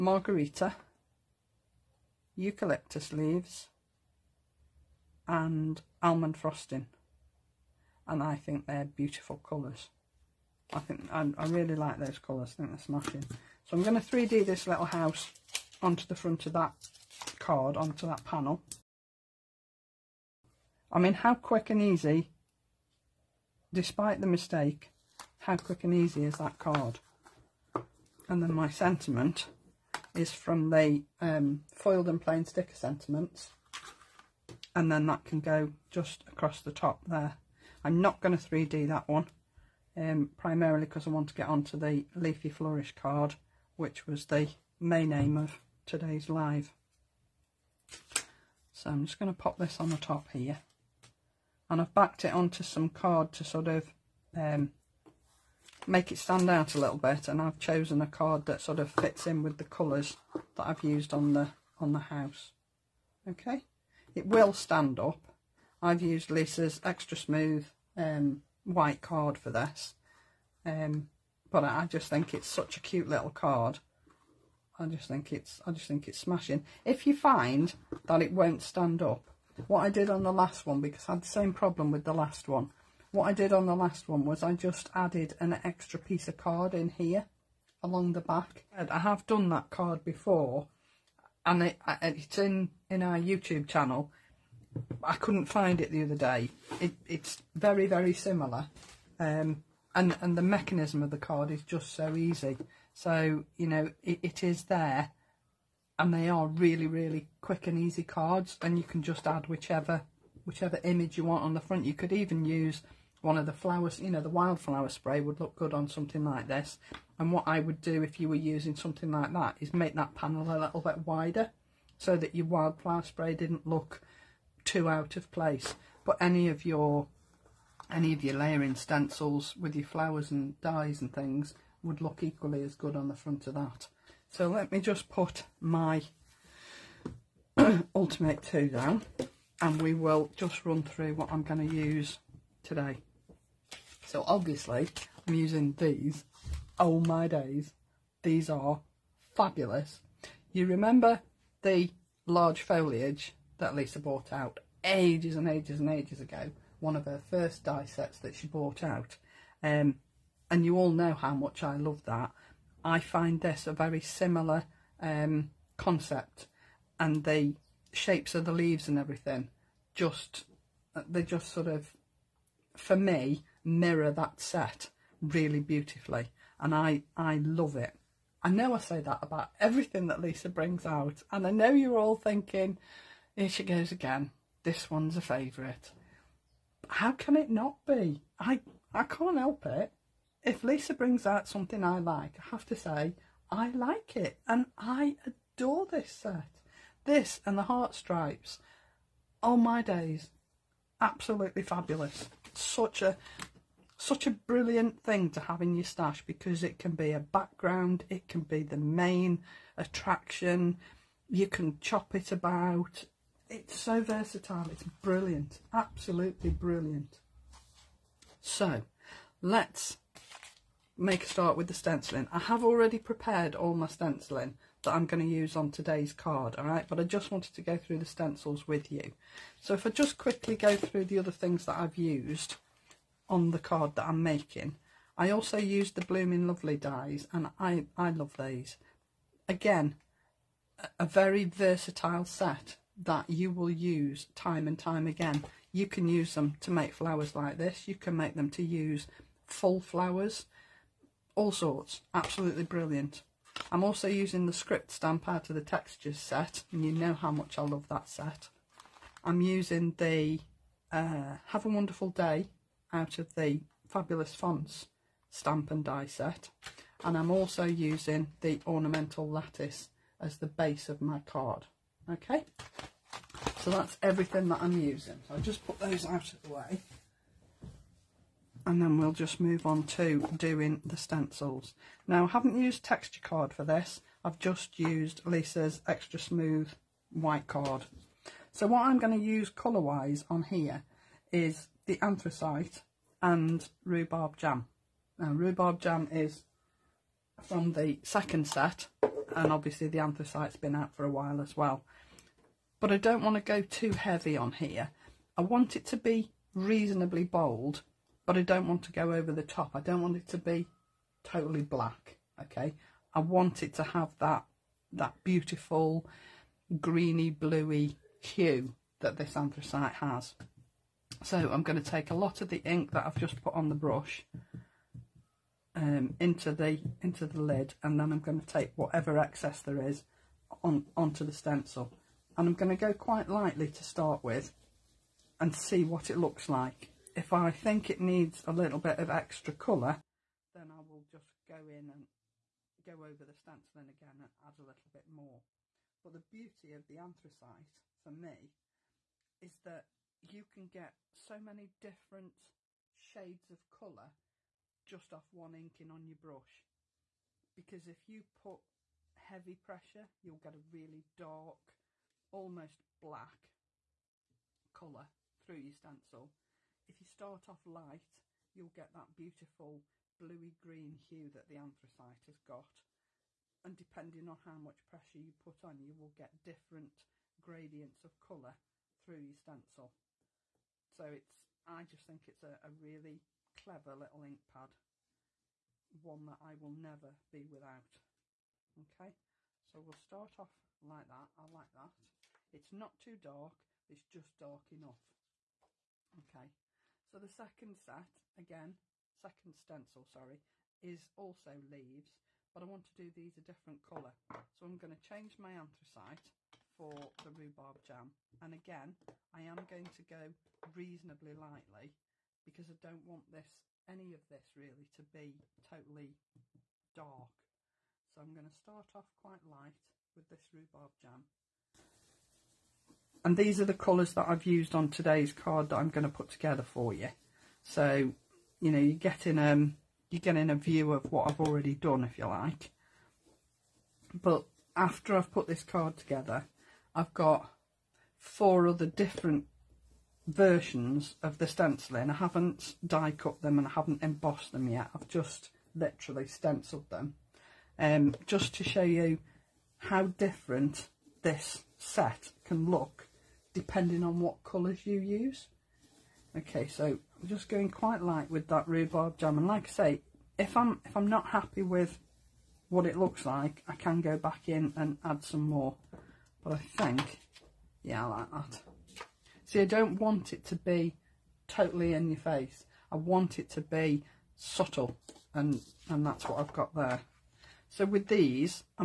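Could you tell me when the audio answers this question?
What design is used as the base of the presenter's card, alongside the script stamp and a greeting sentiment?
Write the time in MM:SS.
04:28.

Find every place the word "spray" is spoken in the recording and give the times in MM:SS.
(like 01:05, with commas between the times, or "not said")
01:54, 02:03.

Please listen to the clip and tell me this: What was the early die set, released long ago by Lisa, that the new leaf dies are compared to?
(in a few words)
large foliage.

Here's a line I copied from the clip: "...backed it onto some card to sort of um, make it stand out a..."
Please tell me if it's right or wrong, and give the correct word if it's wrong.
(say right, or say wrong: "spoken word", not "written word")
right.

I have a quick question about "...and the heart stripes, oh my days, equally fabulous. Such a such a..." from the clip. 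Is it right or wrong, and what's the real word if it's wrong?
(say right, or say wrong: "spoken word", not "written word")
wrong: "absolutely", not "equally".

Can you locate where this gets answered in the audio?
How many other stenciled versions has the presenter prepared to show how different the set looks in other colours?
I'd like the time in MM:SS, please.
07:18.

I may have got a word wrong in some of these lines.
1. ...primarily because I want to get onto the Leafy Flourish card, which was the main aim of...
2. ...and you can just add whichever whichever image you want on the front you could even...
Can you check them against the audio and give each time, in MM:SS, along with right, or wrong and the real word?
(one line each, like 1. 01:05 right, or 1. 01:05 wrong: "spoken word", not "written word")
1. 00:40 right
2. 01:48 right.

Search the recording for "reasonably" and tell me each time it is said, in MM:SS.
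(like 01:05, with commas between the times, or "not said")
05:06, 06:50.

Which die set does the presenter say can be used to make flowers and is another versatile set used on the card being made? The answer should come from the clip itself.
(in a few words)
Blooming Lovely.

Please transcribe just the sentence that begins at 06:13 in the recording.
And depending on how much pressure you put on, you will get different gradients of colour through your stencil.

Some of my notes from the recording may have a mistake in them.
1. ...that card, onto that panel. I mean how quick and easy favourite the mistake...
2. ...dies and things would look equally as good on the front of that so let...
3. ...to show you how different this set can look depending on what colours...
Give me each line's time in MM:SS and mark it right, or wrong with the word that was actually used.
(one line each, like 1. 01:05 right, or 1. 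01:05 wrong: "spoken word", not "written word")
1. 00:16 wrong: "despite", not "favourite"
2. 02:10 right
3. 07:28 right.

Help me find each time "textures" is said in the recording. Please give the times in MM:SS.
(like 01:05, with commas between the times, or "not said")
04:15, 04:42.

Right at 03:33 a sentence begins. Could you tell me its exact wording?
It's so versatile, it's brilliant, absolutely brilliant.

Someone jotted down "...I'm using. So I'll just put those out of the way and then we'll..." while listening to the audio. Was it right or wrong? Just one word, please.
right.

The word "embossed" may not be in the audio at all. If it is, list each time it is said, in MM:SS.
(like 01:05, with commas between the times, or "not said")
07:24.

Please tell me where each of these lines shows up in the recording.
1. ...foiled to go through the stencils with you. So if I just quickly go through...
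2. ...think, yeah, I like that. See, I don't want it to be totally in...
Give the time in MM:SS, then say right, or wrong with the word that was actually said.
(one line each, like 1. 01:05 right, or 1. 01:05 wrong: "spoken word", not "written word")
1. 03:47 wrong: "wanted", not "foiled"
2. 07:46 right.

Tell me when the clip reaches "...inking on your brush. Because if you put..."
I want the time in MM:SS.
05:55.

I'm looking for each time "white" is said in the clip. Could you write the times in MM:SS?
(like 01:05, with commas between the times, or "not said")
01:08, 04:47.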